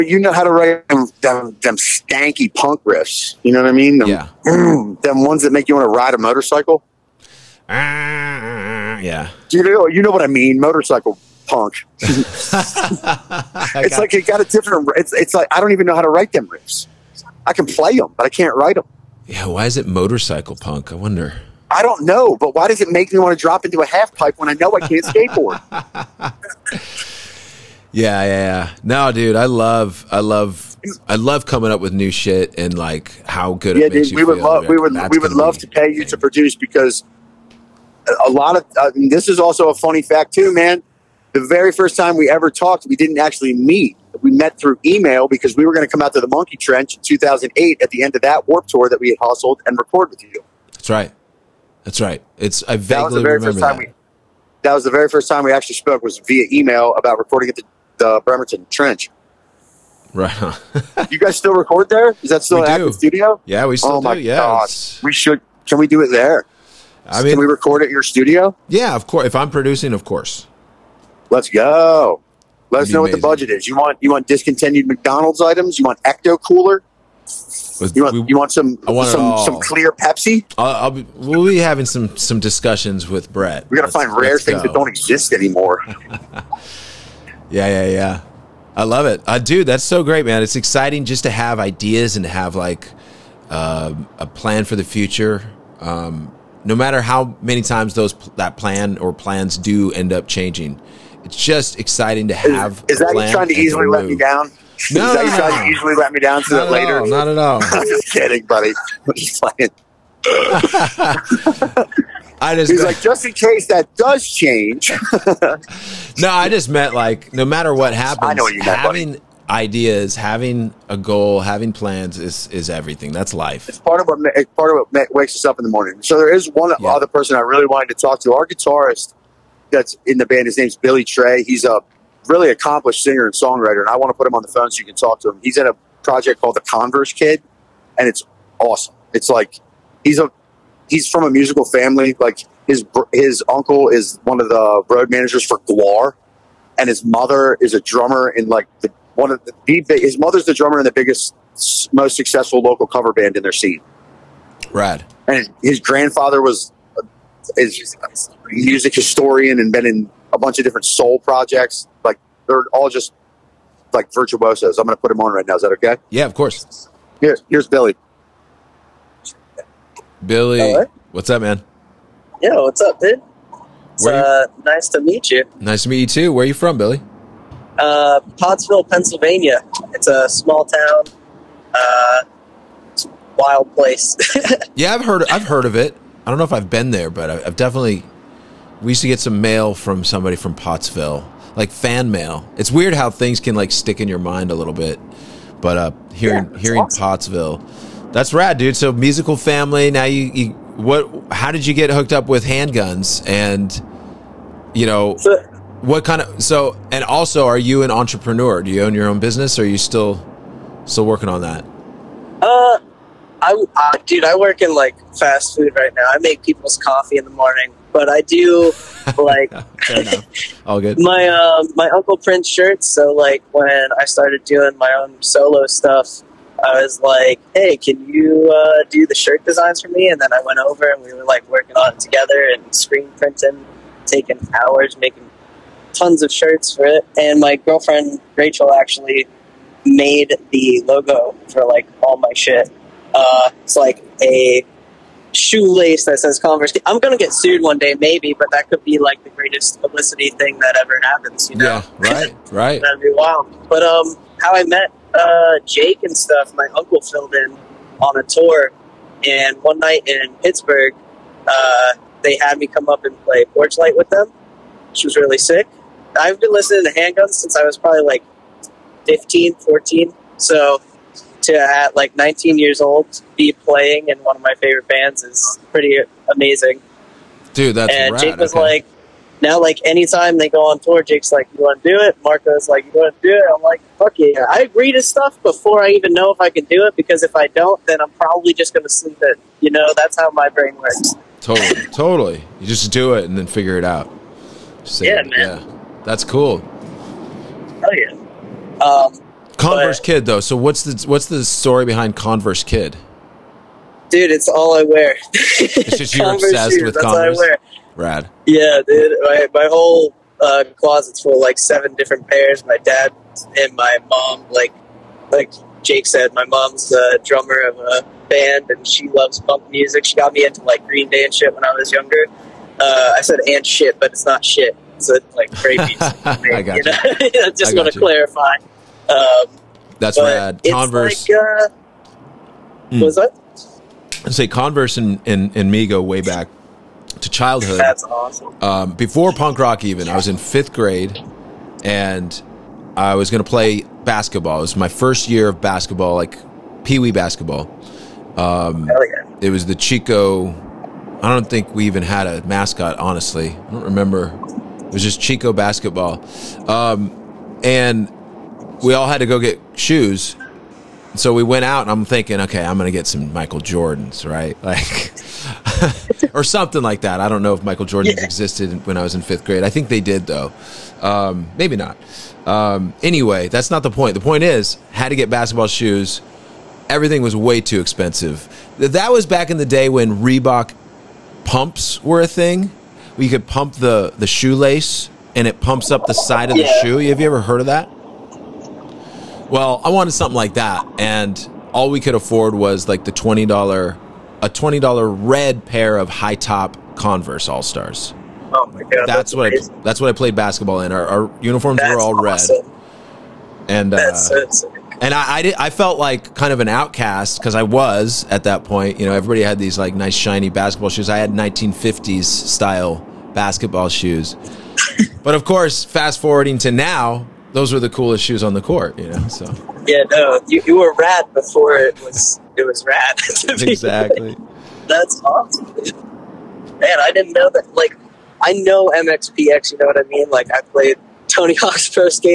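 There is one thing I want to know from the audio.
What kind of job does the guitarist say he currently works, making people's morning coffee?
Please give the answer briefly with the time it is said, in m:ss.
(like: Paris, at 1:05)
fast food, at 3:35.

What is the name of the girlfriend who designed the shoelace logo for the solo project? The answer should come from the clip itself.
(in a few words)
Rachel.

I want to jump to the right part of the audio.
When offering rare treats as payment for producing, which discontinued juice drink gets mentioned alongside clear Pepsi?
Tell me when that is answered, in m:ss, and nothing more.
1:16.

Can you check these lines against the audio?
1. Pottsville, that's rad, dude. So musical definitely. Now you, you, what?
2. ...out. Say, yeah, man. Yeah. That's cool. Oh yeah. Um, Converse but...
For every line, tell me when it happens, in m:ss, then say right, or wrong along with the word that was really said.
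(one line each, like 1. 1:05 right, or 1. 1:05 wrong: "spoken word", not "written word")
1. 3:16 wrong: "family", not "definitely"
2. 4:53 right.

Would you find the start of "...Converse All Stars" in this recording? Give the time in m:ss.
6:36.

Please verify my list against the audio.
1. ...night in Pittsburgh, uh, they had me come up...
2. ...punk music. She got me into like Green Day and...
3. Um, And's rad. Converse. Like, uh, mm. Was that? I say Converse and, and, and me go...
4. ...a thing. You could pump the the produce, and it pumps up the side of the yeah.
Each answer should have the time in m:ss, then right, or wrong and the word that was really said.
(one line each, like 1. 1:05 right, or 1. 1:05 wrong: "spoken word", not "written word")
1. 4:19 right
2. 5:19 right
3. 5:29 wrong: "That", not "And"
4. 6:22 wrong: "shoelace", not "produce".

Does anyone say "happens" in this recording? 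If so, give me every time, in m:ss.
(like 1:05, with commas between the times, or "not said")
1:57, 4:11.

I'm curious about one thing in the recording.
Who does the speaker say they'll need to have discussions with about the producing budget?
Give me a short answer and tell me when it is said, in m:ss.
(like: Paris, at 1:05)
Brett, at 1:23.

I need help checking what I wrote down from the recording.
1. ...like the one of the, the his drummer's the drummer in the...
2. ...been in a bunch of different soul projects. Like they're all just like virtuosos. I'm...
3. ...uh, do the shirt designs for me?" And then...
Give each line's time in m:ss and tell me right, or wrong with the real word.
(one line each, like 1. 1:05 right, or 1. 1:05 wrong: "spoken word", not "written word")
1. 2:28 wrong: "mother", not "drummer"
2. 2:39 right
3. 3:48 right.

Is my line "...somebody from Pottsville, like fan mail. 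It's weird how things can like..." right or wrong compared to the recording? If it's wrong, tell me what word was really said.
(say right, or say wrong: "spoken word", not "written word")
right.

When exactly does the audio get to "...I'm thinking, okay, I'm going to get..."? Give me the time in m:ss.
6:01.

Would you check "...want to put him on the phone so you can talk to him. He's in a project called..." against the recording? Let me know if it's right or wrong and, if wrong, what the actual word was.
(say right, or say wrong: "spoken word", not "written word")
right.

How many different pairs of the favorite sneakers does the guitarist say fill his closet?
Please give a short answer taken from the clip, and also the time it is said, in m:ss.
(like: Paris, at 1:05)
7, at 5:11.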